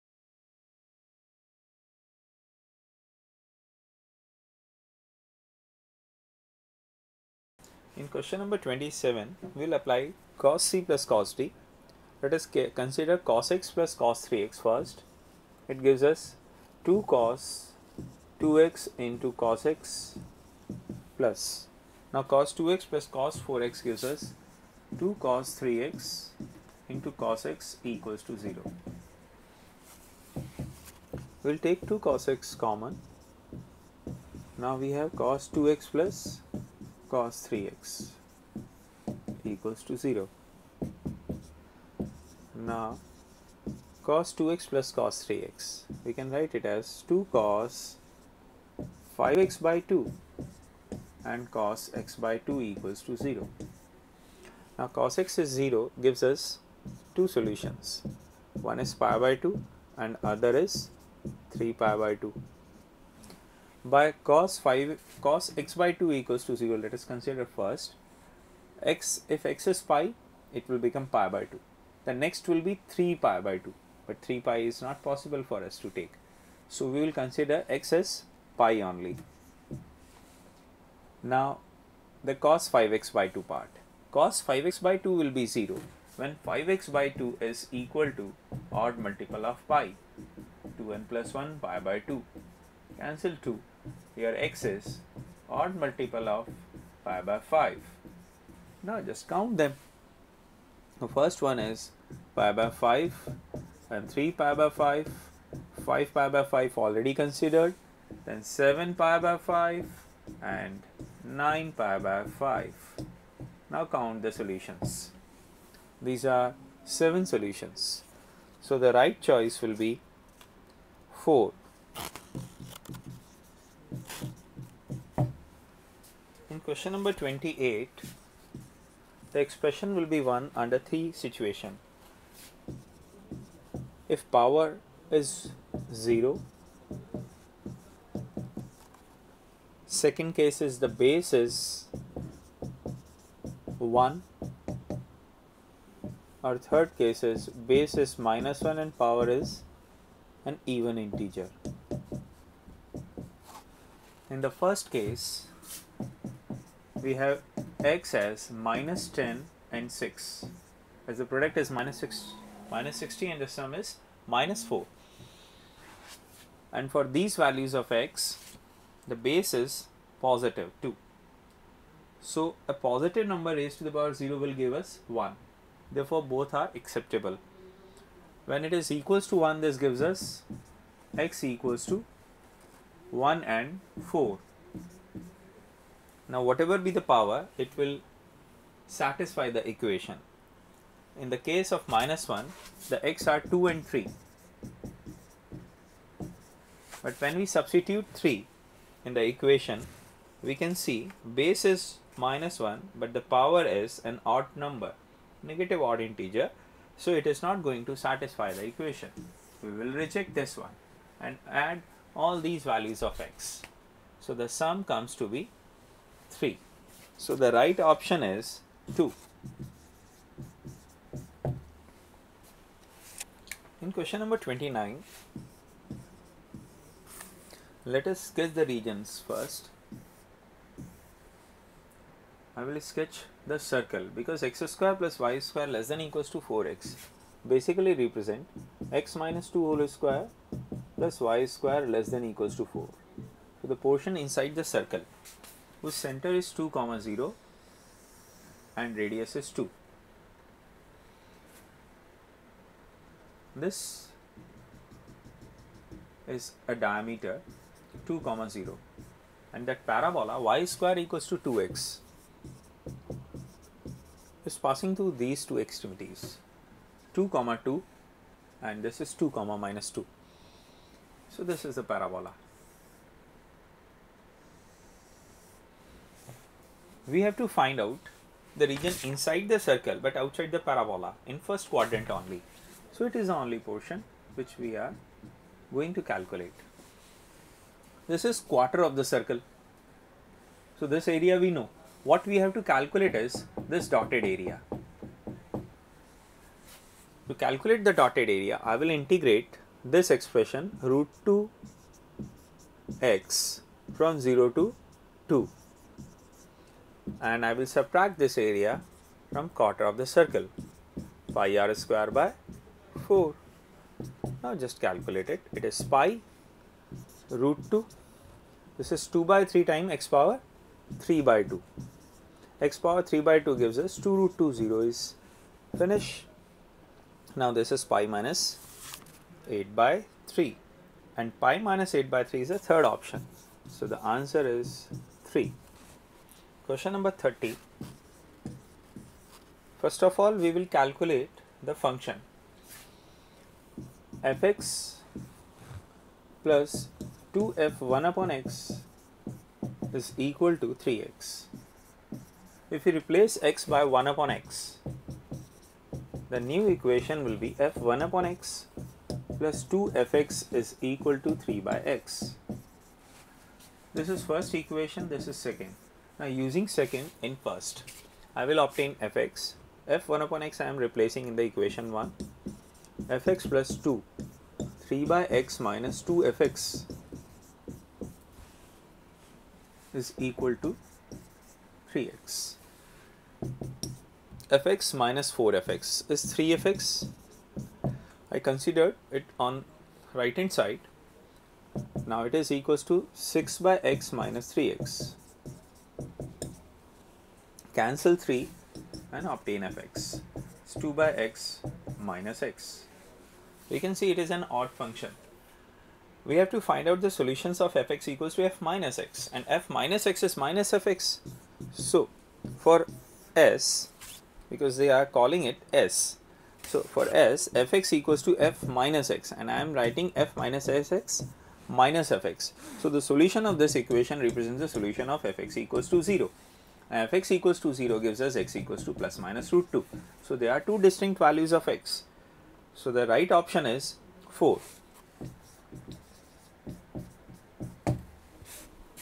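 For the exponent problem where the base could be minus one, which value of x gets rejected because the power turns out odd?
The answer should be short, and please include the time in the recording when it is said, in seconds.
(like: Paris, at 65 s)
3, at 197 s.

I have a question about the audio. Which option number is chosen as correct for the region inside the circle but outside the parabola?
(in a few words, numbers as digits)
3.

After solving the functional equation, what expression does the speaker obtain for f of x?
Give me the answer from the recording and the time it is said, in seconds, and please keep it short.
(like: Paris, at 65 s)
2/x - x, at 400 s.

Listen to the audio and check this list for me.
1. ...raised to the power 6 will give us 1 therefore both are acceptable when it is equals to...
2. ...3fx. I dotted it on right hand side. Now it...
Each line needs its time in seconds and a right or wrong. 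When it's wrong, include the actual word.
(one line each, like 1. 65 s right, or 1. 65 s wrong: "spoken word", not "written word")
1. 173 s wrong: "0", not "6"
2. 386 s wrong: "considered", not "dotted".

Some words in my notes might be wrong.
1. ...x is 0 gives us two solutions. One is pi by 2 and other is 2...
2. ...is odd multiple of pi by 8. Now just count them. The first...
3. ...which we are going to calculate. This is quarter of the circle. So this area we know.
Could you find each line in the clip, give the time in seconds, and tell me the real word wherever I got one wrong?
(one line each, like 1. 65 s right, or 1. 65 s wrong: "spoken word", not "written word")
1. 55 s wrong: "3", not "2"
2. 94 s wrong: "5", not "8"
3. 284 s right.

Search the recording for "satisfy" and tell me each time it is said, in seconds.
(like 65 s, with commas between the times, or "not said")
188 s, 207 s.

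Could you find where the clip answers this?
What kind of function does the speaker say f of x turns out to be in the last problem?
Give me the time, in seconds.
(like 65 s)
404 s.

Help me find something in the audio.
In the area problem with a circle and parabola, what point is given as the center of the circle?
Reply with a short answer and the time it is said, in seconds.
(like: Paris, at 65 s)
(2, 0), at 245 s.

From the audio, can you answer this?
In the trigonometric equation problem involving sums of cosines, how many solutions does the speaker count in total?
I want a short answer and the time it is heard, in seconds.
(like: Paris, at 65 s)
7, at 116 s.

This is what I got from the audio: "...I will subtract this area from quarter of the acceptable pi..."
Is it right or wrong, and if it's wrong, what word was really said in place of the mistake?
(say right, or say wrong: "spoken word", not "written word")
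wrong: "circle", not "acceptable".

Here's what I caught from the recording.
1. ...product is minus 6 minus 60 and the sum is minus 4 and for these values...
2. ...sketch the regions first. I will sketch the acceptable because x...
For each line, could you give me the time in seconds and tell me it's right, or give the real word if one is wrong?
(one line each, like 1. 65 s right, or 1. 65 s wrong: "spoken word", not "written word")
1. 161 s right
2. 228 s wrong: "circle", not "acceptable".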